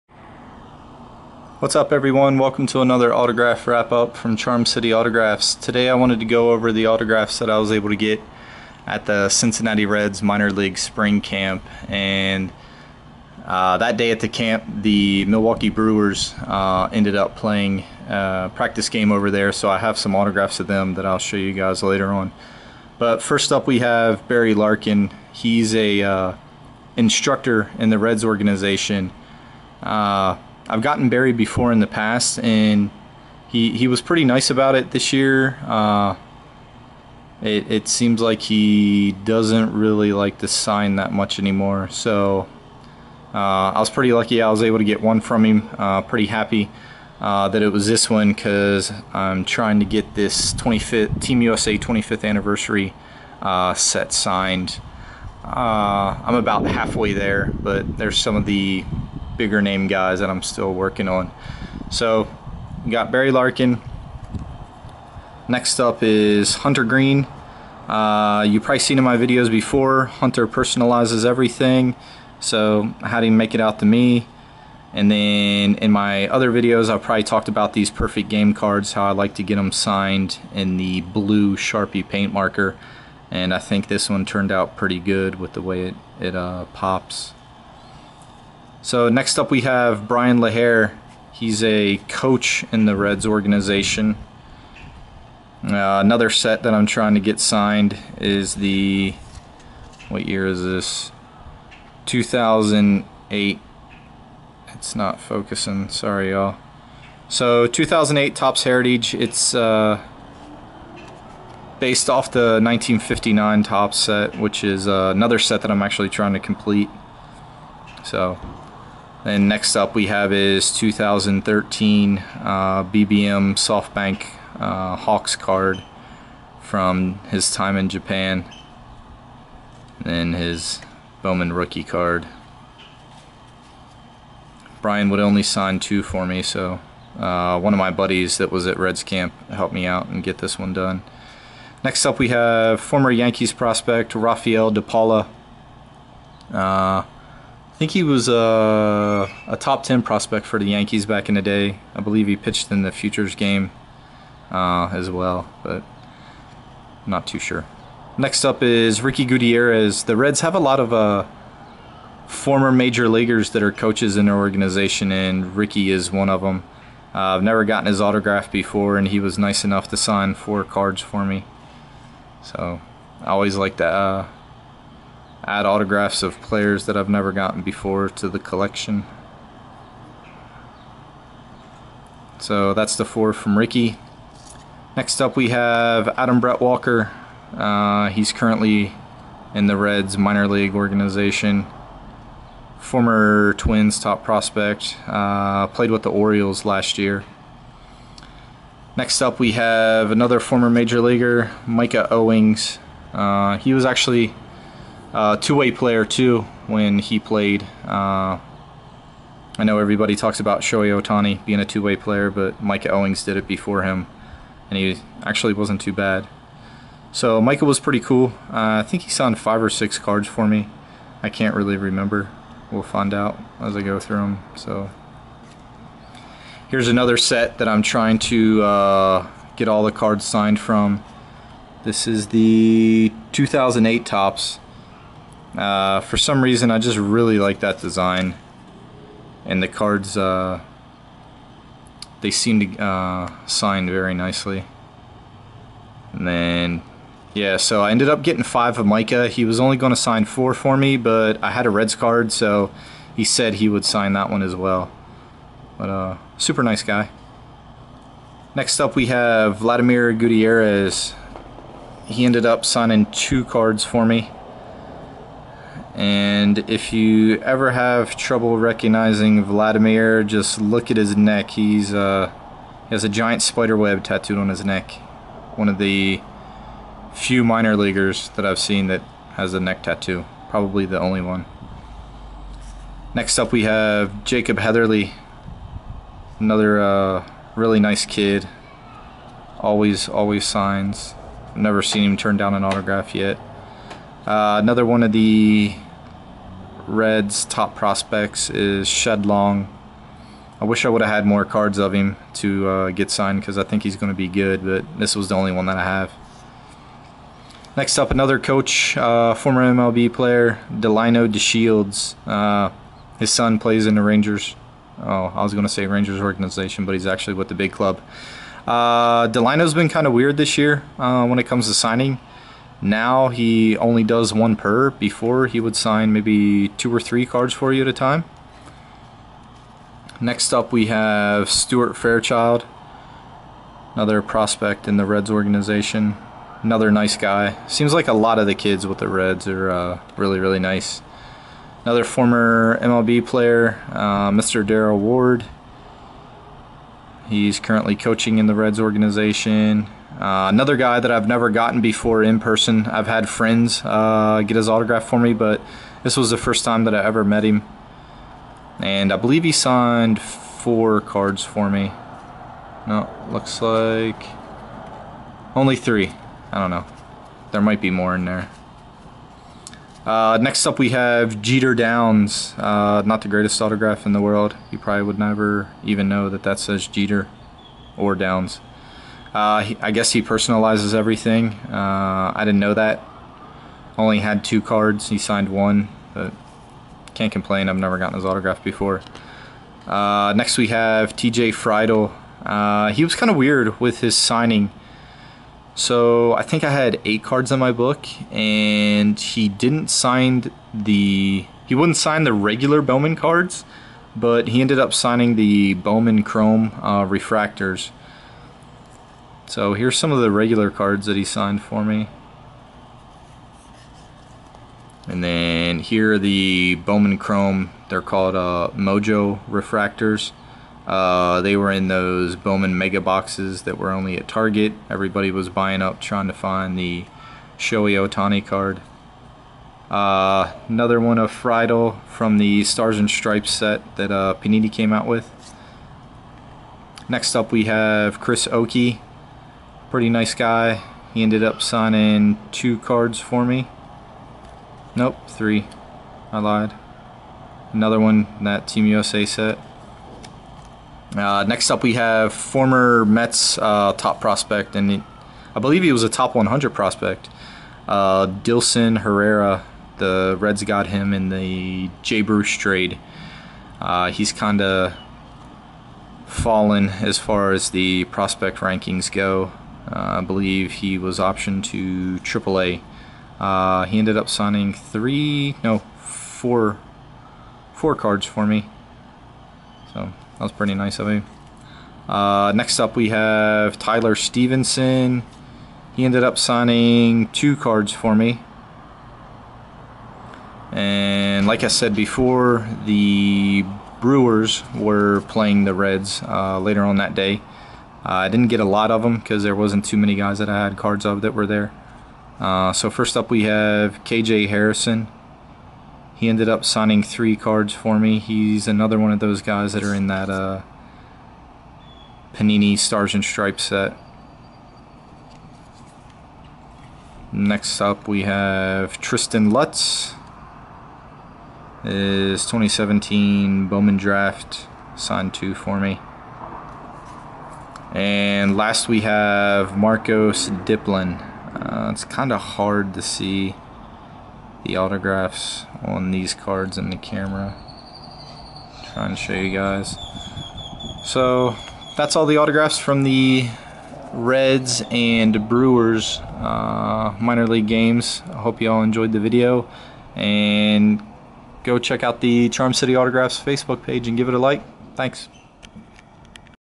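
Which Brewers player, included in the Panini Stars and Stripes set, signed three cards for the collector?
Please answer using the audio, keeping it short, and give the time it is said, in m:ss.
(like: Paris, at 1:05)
KJ Harrison, at 8:24.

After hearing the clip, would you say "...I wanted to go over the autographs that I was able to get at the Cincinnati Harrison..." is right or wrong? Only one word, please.
wrong.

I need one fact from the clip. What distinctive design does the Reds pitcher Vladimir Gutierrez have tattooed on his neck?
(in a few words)
Spider web.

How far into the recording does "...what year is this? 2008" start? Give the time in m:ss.
1:40.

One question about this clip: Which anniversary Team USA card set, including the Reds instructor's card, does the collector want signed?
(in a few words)
25th anniversary.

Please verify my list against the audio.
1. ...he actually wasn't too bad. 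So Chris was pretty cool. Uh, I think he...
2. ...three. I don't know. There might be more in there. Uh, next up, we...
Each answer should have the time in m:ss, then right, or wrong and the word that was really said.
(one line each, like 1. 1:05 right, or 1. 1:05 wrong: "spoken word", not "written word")
1. 3:34 wrong: "Micah", not "Chris"
2. 6:05 right.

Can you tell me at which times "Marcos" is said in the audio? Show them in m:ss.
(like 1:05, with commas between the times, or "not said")
8:49.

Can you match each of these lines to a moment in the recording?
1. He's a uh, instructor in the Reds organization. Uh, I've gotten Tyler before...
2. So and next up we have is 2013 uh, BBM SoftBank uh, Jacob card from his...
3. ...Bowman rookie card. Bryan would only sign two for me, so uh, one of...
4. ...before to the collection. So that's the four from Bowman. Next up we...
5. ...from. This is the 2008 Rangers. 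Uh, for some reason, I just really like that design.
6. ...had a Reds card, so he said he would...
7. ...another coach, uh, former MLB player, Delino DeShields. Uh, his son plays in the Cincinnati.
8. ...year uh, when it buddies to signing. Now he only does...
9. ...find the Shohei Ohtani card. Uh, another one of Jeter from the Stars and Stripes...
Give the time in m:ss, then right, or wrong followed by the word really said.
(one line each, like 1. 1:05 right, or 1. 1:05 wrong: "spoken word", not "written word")
1. 0:25 wrong: "Barry", not "Tyler"
2. 1:58 wrong: "Hawks", not "Jacob"
3. 2:11 right
4. 2:57 wrong: "Ricky", not "Bowman"
5. 3:50 wrong: "Topps", not "Rangers"
6. 4:11 right
7. 5:08 wrong: "Rangers", not "Cincinnati"
8. 5:20 wrong: "comes", not "buddies"
9. 7:06 wrong: "Friedl", not "Jeter".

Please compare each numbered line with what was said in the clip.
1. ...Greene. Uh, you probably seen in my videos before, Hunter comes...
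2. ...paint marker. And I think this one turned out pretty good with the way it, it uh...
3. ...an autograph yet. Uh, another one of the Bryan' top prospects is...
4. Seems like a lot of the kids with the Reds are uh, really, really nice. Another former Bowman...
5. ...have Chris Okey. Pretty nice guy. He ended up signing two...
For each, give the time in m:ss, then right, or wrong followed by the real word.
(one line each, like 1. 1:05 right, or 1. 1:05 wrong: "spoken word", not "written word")
1. 1:06 wrong: "personalizes", not "comes"
2. 1:22 right
3. 4:52 wrong: "Reds", not "Bryan"
4. 5:37 wrong: "MLB", not "Bowman"
5. 7:17 right.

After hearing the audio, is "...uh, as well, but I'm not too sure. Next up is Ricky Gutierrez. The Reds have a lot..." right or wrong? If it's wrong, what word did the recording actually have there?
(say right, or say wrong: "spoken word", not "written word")
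right.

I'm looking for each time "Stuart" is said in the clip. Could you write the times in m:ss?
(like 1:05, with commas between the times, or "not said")
5:31.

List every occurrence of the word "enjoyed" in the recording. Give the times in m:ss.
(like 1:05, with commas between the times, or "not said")
9:08.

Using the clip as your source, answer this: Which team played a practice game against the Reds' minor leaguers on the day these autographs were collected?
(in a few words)
Milwaukee Brewers.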